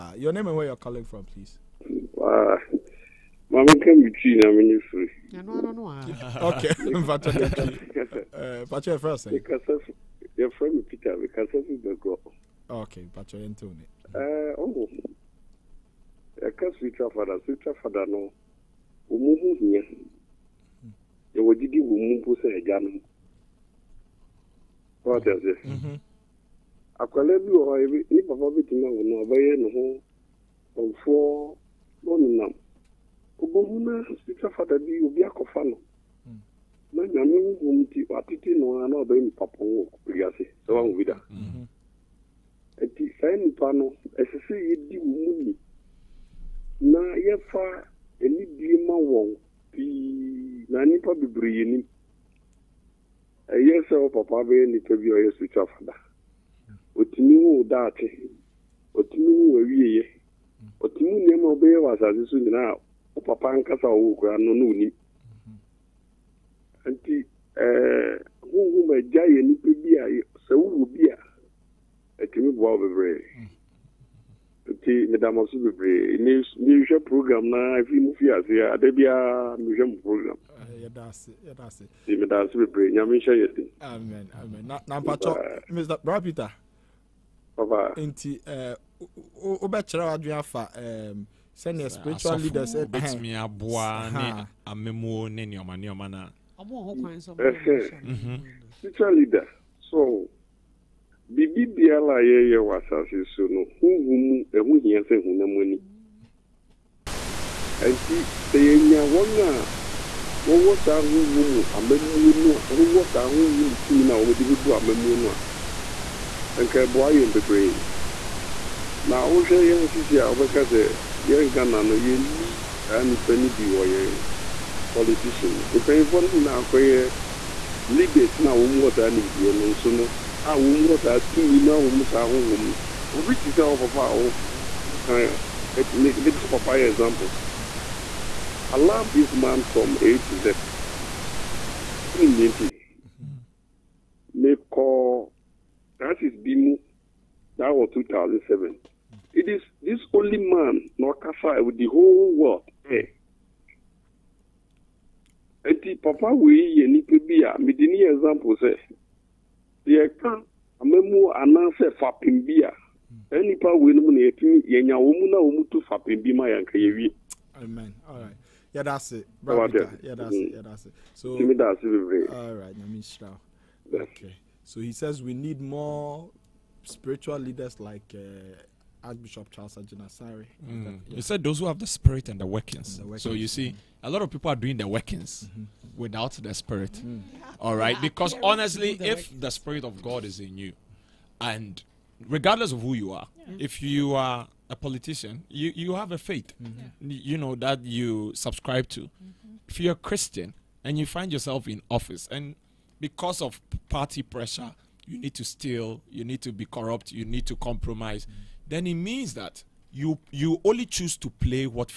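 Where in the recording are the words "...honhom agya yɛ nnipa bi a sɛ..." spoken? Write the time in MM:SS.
01:08.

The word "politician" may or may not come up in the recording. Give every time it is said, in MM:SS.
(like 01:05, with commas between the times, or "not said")
02:04, 03:14.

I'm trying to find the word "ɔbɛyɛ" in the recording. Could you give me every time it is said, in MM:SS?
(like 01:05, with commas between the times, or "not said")
00:29, 00:39.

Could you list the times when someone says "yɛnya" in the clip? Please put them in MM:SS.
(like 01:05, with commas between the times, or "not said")
01:48, 02:44.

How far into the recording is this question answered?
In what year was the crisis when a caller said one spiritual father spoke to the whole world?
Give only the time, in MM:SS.
02:27.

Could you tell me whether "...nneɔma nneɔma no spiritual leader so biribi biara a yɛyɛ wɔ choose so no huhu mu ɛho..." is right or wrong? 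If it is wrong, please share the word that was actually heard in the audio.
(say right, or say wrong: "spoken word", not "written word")
wrong: "asase", not "choose".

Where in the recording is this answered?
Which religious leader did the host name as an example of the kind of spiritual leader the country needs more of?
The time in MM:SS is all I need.
02:59.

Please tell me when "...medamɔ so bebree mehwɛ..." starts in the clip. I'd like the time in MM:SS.
01:15.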